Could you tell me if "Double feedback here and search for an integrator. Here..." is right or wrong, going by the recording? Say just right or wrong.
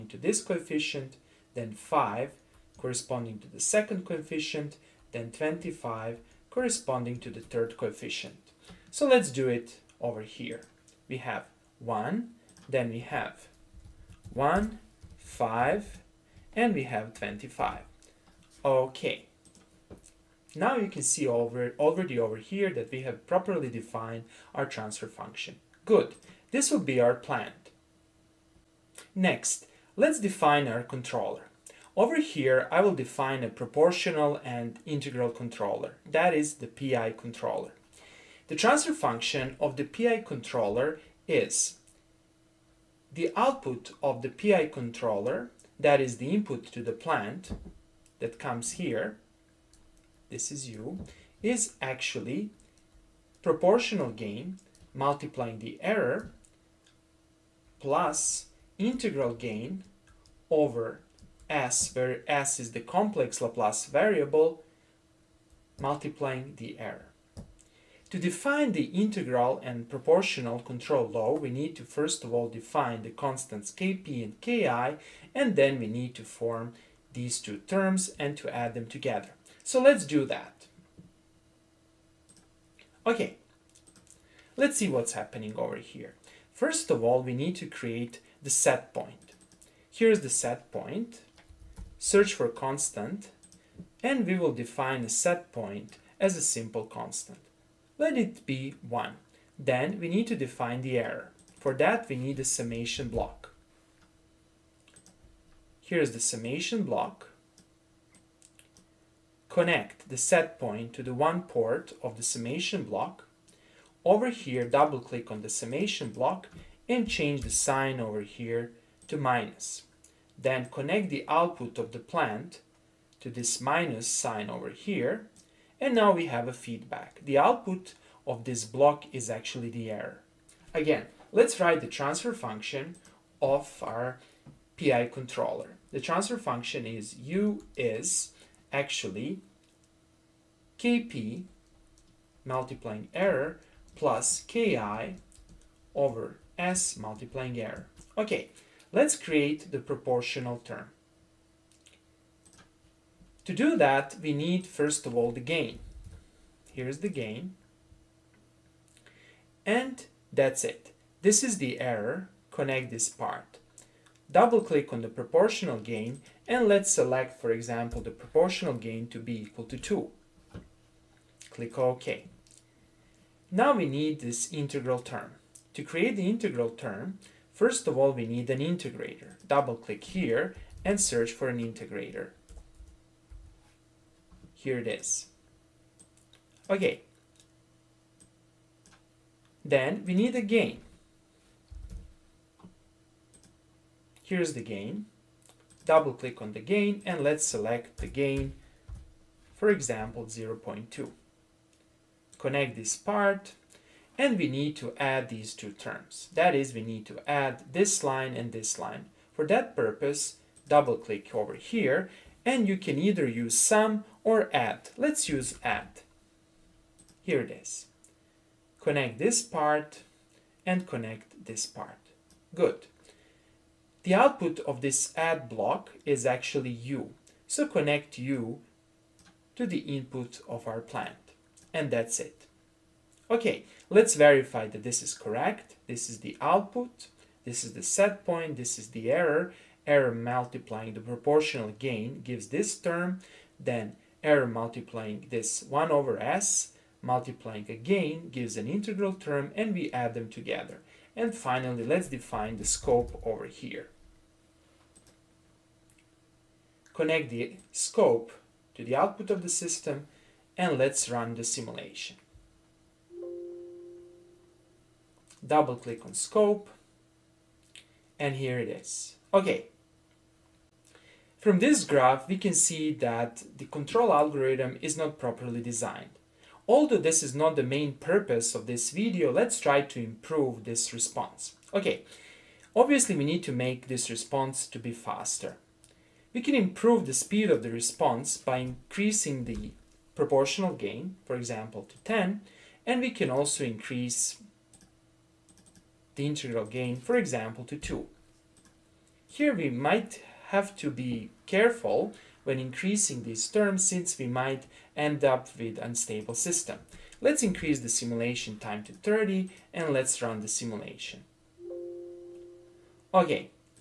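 wrong.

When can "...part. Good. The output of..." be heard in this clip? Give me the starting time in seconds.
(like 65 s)
221 s.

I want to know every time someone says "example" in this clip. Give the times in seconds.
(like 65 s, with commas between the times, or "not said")
167 s, 199 s, 291 s, 297 s.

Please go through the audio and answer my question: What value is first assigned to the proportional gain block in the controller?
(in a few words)
2.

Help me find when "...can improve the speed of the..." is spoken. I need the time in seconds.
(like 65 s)
286 s.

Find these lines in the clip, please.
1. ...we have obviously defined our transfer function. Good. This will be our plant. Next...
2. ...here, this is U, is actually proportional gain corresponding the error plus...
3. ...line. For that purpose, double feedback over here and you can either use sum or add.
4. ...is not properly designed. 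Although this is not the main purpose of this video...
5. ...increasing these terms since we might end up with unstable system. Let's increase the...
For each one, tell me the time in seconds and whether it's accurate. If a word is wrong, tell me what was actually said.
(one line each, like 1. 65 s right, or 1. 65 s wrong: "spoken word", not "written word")
1. 22 s wrong: "properly", not "obviously"
2. 48 s wrong: "multiplying", not "corresponding"
3. 208 s wrong: "click", not "feedback"
4. 274 s right
5. 302 s right.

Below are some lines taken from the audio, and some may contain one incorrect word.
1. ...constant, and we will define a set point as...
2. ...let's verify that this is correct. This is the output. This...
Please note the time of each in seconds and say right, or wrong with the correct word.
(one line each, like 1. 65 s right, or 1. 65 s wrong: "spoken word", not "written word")
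1. 92 s right
2. 233 s right.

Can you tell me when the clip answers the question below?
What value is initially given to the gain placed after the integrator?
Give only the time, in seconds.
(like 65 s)
200 s.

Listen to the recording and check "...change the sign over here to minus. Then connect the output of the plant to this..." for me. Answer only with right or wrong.
right.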